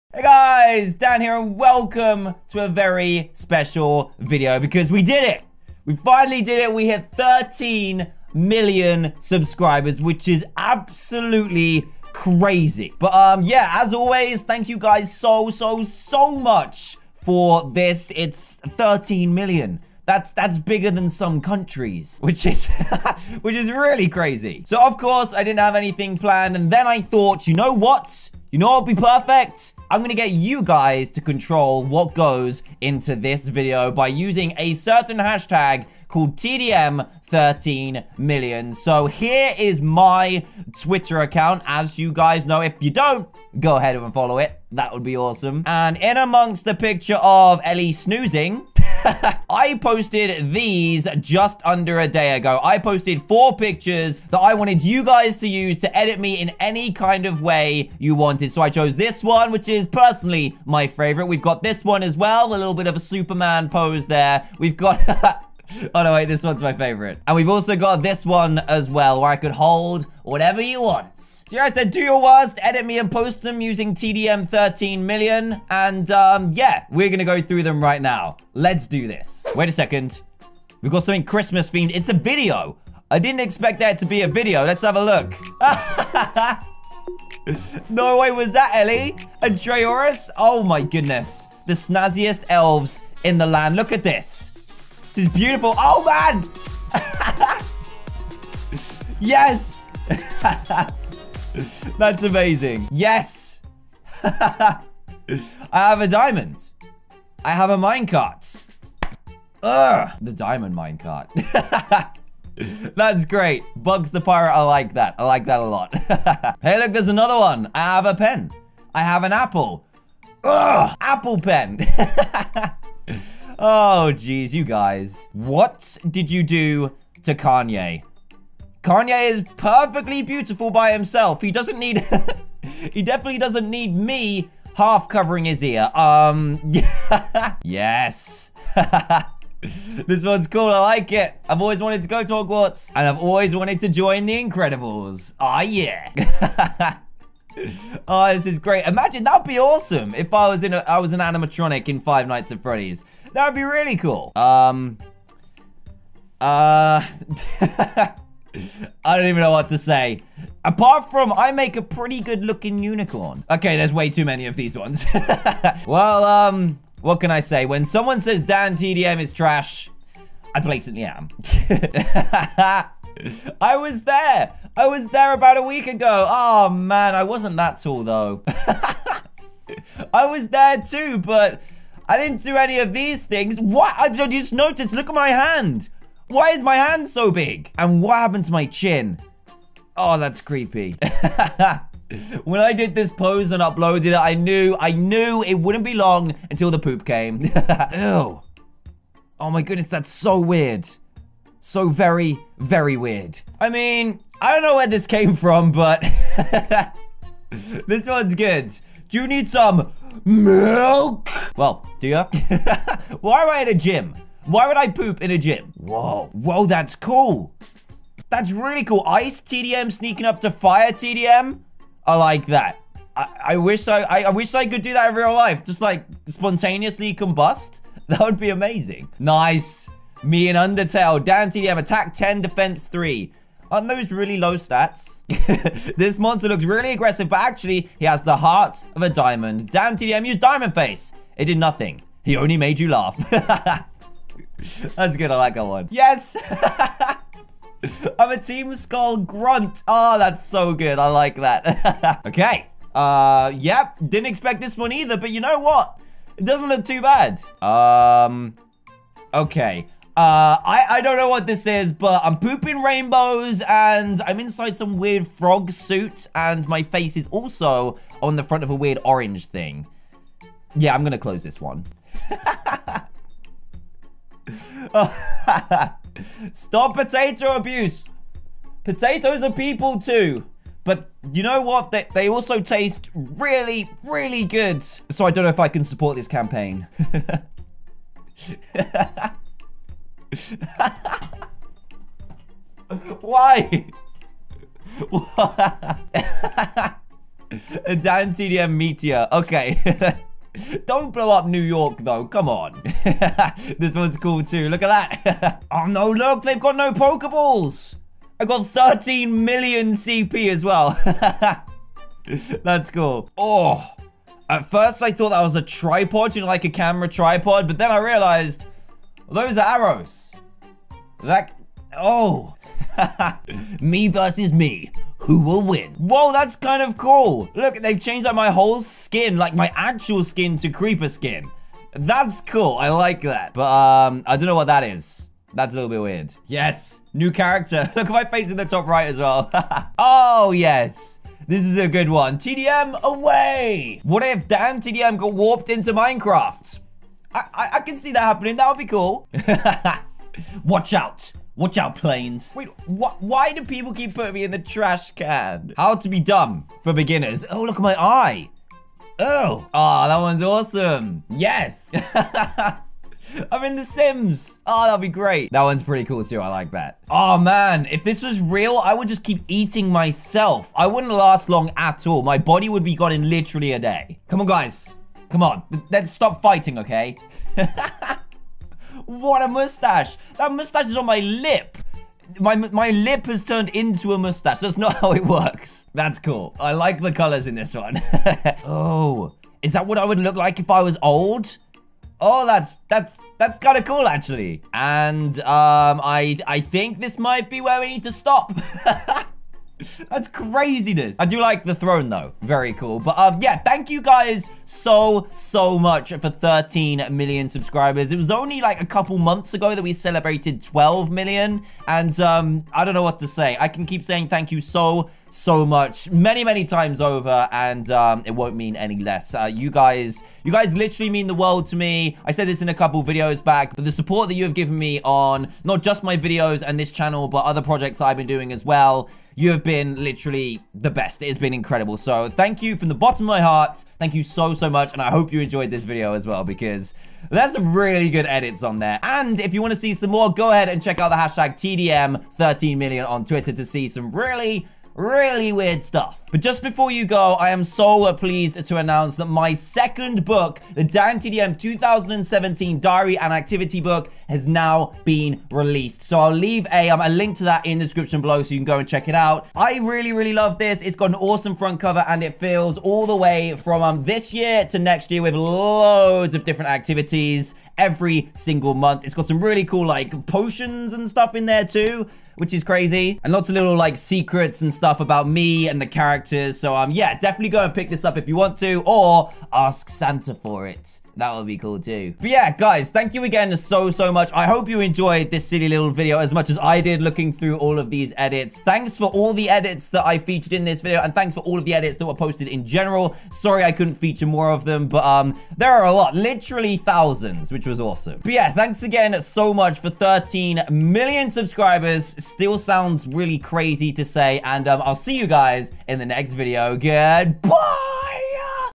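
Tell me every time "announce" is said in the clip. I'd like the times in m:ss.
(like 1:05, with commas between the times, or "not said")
7:28.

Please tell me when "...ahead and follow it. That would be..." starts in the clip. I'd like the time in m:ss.
0:43.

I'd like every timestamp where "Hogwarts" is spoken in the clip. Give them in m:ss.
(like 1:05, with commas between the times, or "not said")
2:22.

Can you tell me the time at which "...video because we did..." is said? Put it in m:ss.
0:04.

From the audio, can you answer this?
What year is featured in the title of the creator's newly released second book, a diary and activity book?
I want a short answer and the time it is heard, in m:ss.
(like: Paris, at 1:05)
2017, at 7:31.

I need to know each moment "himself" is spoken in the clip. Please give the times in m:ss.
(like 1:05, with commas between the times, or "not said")
2:10.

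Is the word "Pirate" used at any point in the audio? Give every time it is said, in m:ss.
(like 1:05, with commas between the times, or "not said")
1:54.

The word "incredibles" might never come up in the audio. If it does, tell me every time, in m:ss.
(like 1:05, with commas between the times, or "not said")
2:24, 7:11.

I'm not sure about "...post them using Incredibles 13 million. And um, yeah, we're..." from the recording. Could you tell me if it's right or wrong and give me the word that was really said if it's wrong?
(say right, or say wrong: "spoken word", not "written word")
wrong: "TDM", not "Incredibles".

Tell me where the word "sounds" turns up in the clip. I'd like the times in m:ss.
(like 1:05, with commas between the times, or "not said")
8:22.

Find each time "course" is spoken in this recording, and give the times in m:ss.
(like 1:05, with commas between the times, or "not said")
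0:24.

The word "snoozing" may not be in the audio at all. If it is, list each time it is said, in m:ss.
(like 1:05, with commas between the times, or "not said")
0:47.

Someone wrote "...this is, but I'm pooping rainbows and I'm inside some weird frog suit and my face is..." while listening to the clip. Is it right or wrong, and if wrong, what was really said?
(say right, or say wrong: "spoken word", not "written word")
right.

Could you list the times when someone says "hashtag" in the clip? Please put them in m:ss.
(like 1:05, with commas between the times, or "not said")
0:35, 7:21.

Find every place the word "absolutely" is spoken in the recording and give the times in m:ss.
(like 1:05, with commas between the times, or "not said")
0:10.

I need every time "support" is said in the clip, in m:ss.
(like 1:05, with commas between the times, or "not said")
4:45, 7:03.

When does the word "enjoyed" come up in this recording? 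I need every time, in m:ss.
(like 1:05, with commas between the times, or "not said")
7:15, 8:04.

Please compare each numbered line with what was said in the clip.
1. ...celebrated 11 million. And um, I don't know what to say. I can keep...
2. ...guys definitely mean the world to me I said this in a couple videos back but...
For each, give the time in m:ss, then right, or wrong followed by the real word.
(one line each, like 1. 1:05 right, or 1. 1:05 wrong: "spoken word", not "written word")
1. 6:49 wrong: "12", not "11"
2. 7:00 wrong: "literally", not "definitely".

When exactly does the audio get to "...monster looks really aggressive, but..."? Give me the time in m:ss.
3:56.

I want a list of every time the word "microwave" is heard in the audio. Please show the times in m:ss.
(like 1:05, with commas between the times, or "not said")
not said.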